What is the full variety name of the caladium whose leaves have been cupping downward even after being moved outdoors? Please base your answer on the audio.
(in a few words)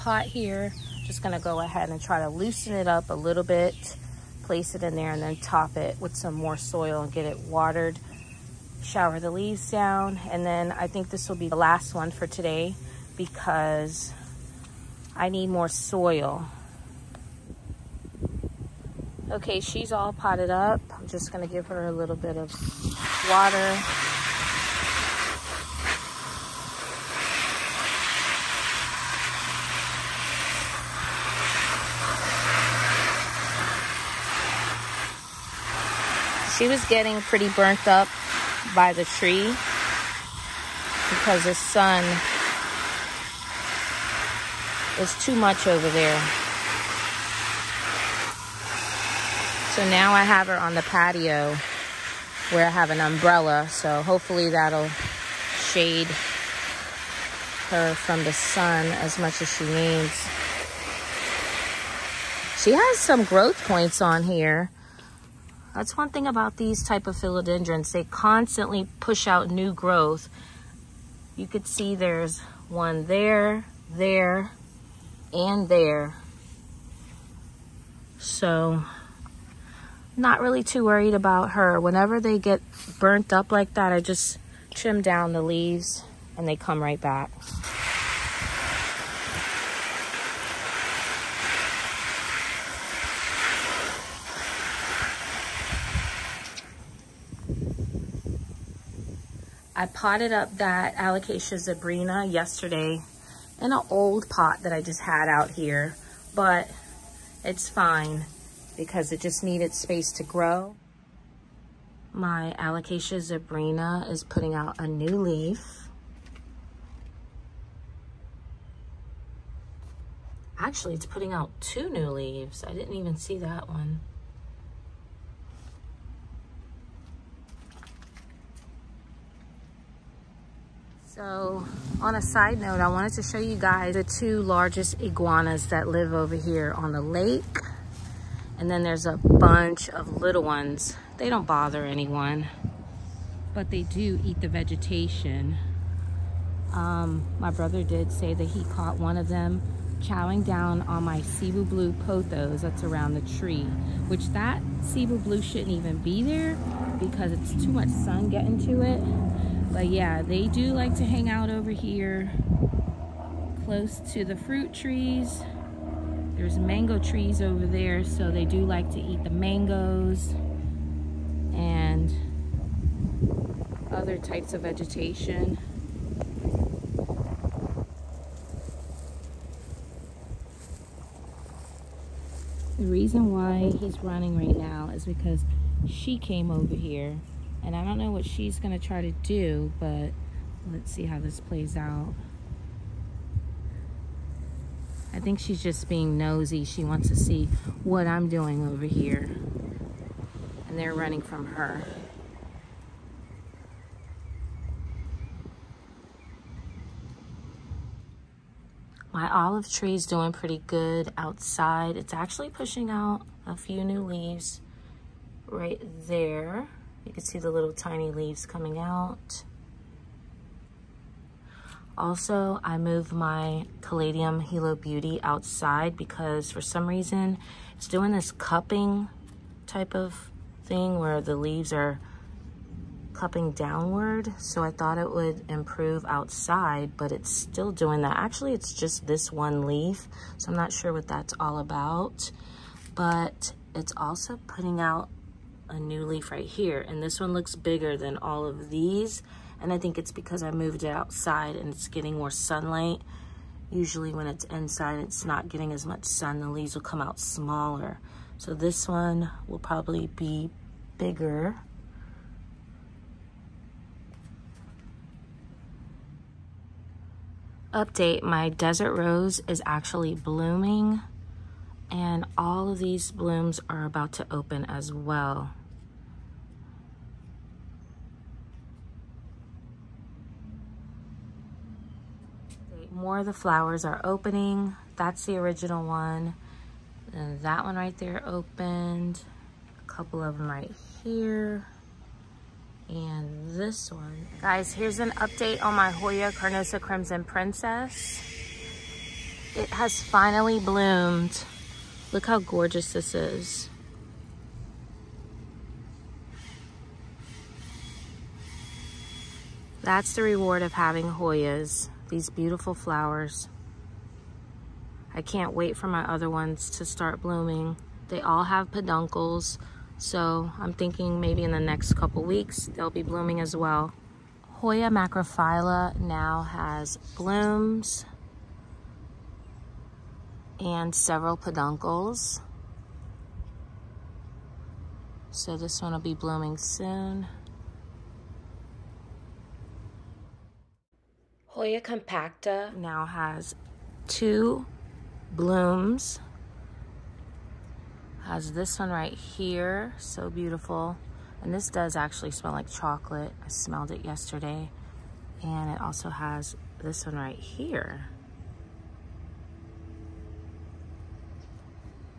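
Hilo Beauty.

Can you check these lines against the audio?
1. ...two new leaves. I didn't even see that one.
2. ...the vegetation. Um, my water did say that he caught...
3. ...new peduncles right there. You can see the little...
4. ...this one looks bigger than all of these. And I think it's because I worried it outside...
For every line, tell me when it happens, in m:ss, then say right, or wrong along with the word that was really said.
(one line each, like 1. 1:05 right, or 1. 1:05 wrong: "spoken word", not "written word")
1. 2:01 right
2. 2:24 wrong: "brother", not "water"
3. 3:33 wrong: "leaves", not "peduncles"
4. 4:07 wrong: "moved", not "worried".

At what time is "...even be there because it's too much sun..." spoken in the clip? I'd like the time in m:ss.
2:35.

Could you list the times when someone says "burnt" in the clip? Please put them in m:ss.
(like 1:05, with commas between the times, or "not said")
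0:37, 1:22.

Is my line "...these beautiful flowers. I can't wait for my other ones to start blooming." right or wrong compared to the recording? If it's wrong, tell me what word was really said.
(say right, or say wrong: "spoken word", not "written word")
right.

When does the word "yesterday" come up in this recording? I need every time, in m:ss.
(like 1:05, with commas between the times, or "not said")
1:42, 5:54.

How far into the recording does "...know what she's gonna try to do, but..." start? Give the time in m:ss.
3:07.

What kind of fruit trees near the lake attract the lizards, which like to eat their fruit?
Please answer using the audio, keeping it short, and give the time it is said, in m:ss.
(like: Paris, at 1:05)
Mango, at 2:46.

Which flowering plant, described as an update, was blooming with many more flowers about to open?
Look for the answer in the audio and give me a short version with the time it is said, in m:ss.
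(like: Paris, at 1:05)
Desert rose, at 4:28.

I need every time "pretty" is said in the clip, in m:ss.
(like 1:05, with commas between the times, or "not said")
0:37, 3:30.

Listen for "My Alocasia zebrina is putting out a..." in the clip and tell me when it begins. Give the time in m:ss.
1:52.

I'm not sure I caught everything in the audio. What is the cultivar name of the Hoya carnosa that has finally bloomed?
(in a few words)
Crimson Princess.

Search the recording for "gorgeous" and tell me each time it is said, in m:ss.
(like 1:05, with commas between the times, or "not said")
5:02.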